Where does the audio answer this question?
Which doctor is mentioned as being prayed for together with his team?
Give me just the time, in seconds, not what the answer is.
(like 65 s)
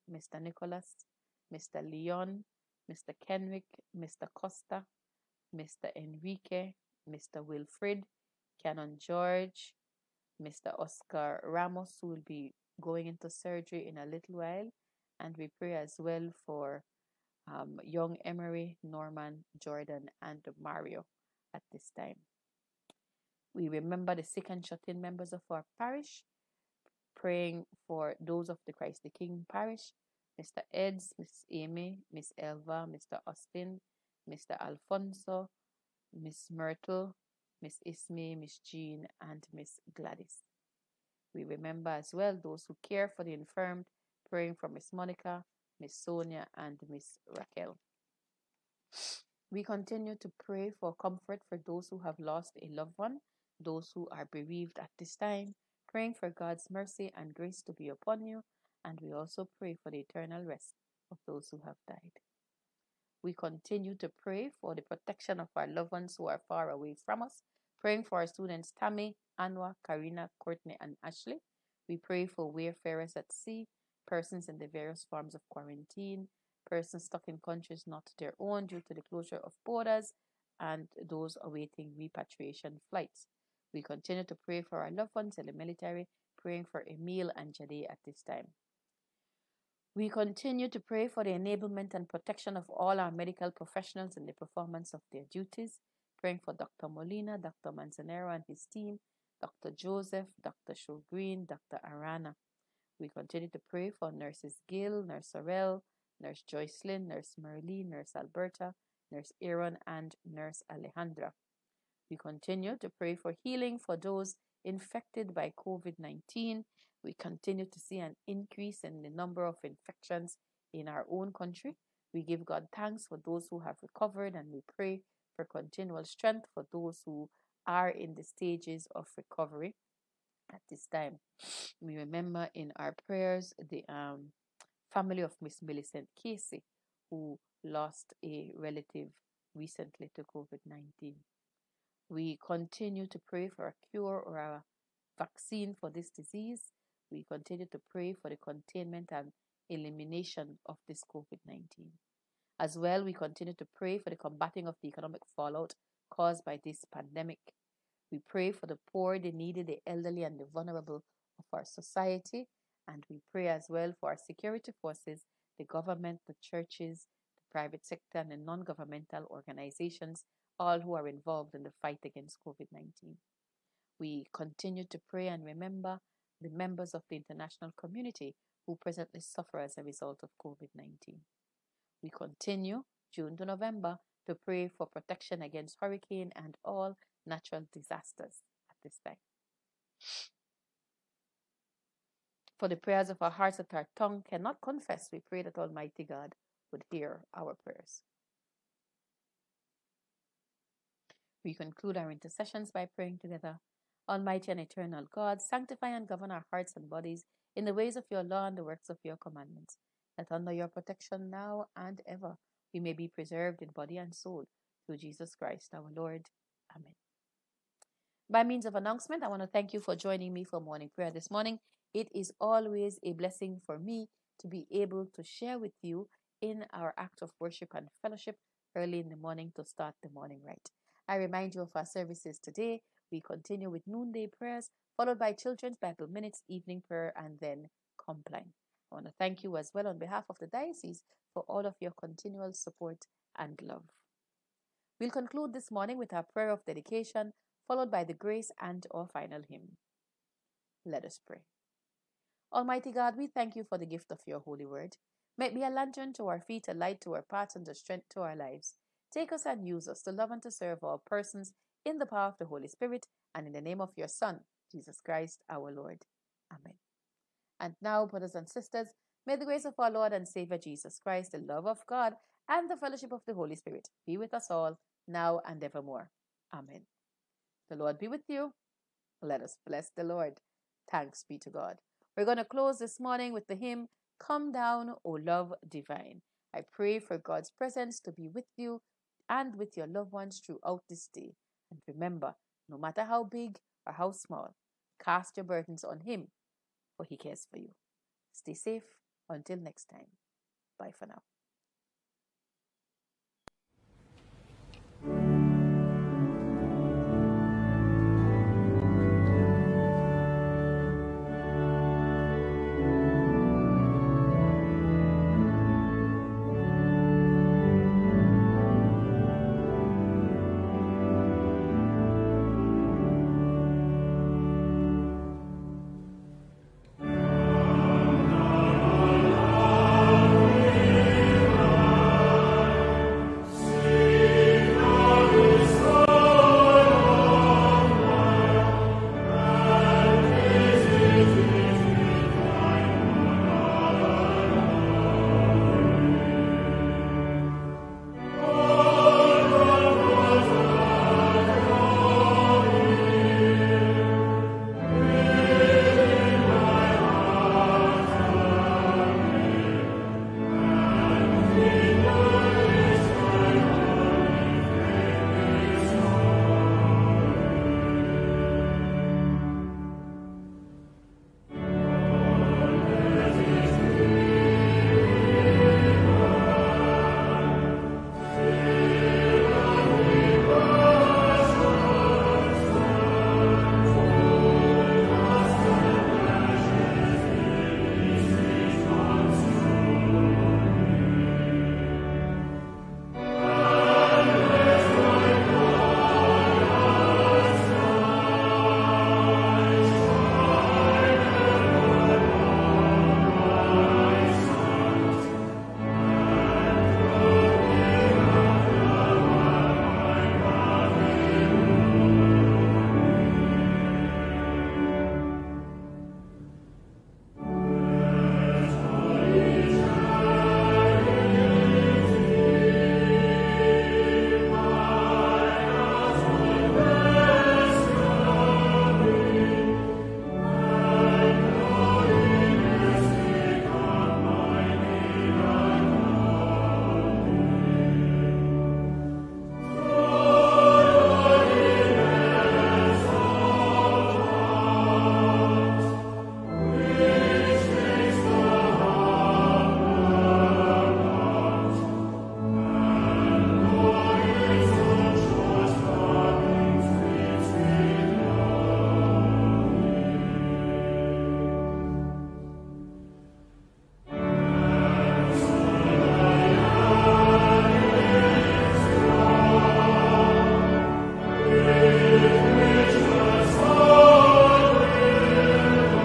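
97 s.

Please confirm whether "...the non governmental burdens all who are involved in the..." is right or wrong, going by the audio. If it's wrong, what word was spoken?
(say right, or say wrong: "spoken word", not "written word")
wrong: "organizations", not "burdens".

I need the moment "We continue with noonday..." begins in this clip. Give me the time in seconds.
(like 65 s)
233 s.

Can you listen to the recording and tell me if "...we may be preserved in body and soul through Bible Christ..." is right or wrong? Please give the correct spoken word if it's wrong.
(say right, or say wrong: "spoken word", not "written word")
wrong: "Jesus", not "Bible".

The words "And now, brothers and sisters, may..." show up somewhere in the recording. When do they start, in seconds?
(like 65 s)
267 s.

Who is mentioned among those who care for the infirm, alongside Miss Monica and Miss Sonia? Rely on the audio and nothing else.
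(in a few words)
Miss Raquel.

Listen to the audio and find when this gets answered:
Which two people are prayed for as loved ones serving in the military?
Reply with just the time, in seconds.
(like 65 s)
86 s.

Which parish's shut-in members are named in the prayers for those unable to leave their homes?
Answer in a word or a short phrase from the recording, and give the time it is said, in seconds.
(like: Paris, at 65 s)
Christ the King, at 28 s.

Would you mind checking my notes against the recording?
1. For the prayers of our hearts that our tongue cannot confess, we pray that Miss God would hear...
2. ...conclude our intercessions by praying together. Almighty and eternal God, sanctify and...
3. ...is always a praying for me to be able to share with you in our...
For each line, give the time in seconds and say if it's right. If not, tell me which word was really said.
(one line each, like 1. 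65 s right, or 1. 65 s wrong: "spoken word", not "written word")
1. 192 s wrong: "Almighty", not "Miss"
2. 201 s right
3. 222 s wrong: "blessing", not "praying".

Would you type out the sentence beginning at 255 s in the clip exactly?
May it be a lantern to our feet, a light to our path, and a strength to our lives.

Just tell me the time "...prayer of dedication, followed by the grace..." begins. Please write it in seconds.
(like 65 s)
246 s.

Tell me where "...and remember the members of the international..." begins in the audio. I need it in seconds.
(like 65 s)
175 s.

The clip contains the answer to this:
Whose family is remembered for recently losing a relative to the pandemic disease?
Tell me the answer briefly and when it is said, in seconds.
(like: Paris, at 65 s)
Miss Millicent Casey, at 135 s.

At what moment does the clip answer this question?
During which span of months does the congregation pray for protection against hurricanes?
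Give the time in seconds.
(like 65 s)
183 s.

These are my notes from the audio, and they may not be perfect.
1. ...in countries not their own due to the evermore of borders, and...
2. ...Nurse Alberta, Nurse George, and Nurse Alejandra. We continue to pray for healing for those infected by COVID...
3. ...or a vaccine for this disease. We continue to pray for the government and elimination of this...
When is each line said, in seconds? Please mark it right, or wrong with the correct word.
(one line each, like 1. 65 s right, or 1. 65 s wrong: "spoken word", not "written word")
1. 77 s wrong: "closure", not "evermore"
2. 107 s wrong: "Aaron", not "George"
3. 144 s wrong: "containment", not "government".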